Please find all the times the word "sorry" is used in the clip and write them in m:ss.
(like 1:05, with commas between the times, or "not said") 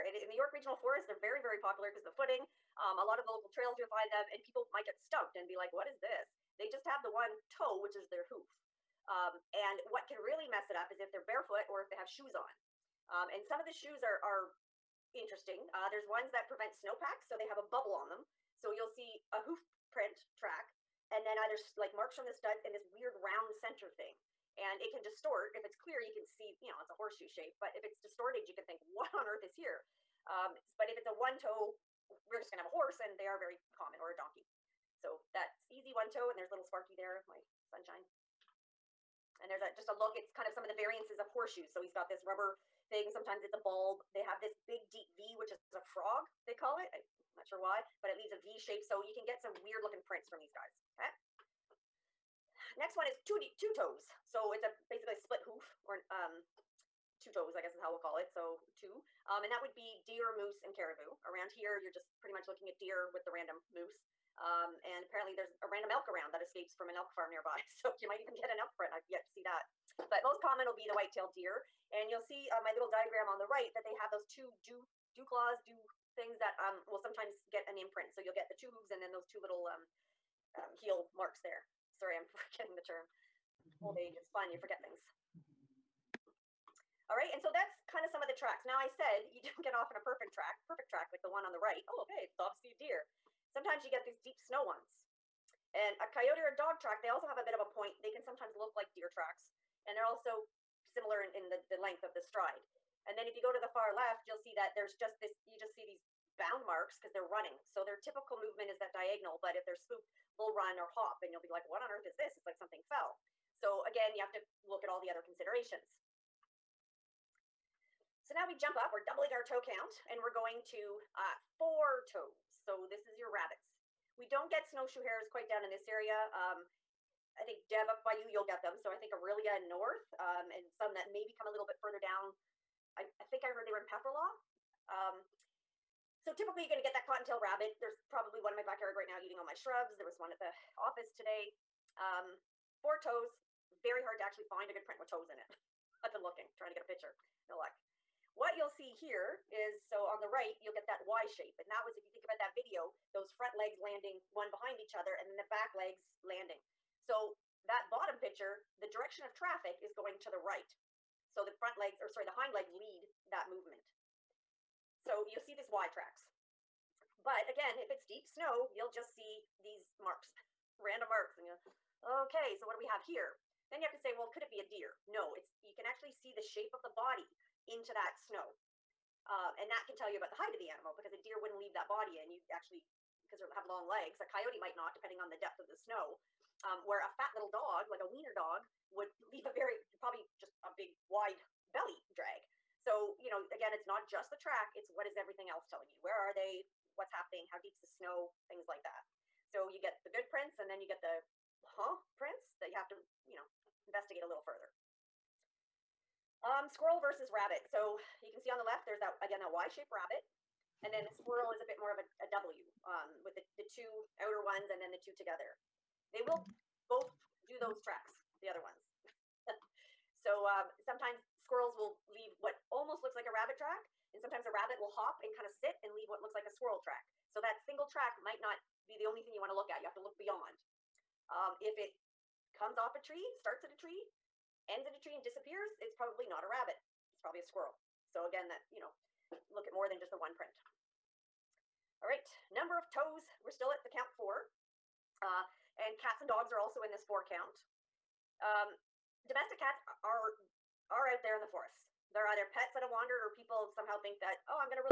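1:21, 2:42.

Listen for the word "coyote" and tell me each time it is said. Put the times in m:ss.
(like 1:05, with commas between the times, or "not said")
1:36, 3:04.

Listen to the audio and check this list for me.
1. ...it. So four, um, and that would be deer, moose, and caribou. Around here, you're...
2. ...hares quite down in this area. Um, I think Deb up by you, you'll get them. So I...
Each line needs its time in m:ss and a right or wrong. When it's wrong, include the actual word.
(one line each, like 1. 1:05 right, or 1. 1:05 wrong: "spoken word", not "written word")
1. 0:58 wrong: "two", not "four"
2. 2:05 right.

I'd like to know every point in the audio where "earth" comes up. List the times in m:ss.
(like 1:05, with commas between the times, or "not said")
0:29, 1:51.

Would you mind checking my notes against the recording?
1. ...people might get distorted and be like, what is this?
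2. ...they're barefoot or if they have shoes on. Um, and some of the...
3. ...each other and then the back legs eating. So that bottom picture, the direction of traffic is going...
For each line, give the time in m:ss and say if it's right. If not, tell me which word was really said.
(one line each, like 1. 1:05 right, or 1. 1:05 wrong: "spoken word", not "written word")
1. 0:04 wrong: "stumped", not "distorted"
2. 0:11 right
3. 2:34 wrong: "landing", not "eating".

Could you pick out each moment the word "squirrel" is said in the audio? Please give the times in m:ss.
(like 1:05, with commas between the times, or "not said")
3:26, 3:31, 3:41, 3:46, 3:57.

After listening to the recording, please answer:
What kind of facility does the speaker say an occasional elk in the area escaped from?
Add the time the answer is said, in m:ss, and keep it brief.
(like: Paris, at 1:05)
an elk farm, at 1:06.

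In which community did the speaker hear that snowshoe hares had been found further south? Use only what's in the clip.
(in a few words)
Pefferlaw.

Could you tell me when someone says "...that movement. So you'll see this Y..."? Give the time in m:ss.
2:43.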